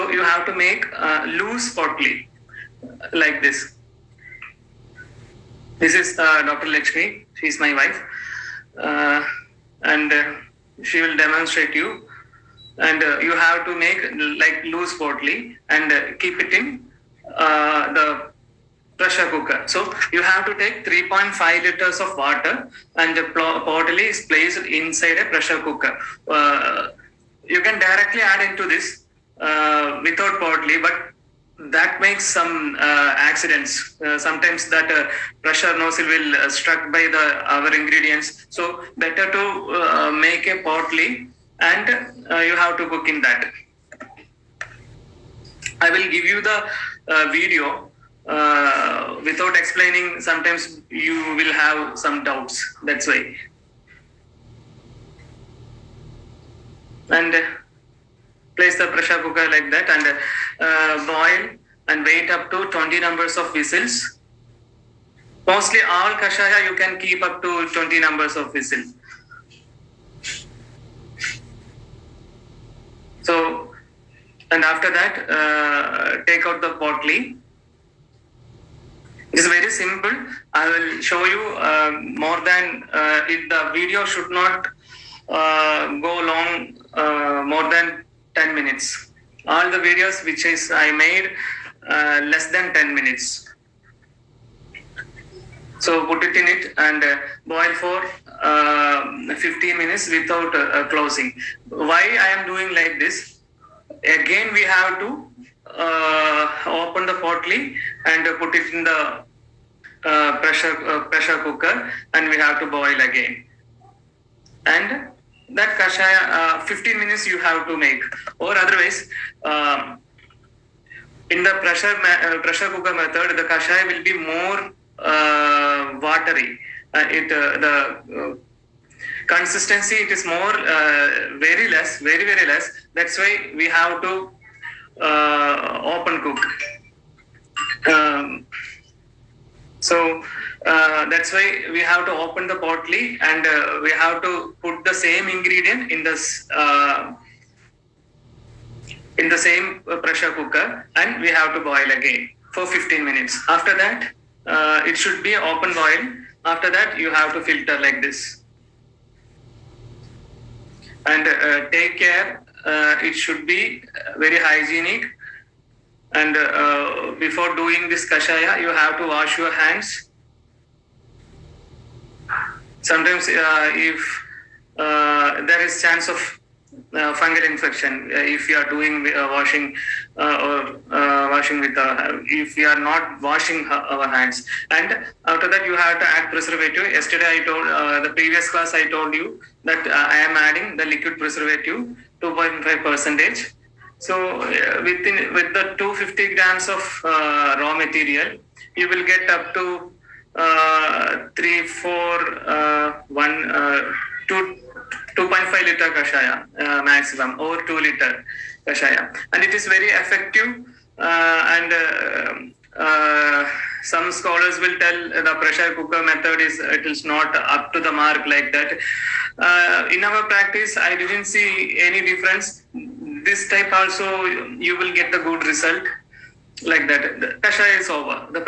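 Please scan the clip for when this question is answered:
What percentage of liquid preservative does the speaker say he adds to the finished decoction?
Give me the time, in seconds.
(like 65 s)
192 s.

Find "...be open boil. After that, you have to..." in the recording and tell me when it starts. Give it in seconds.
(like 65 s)
155 s.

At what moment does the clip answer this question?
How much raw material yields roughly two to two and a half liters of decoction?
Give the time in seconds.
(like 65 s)
195 s.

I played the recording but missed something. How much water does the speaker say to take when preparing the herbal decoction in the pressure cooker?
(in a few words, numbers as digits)
3.5 liters.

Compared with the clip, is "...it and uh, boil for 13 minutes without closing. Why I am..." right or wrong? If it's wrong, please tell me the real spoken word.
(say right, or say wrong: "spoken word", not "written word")
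wrong: "15", not "13".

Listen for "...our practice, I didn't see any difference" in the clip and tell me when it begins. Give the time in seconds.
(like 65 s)
220 s.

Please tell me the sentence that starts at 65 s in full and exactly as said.
Mostly all kashaya you can keep up to 20 numbers of whistles.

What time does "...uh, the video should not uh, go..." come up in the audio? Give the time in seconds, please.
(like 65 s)
82 s.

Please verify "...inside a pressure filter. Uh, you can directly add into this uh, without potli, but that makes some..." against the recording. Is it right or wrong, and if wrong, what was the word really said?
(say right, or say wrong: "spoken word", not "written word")
wrong: "cooker", not "filter".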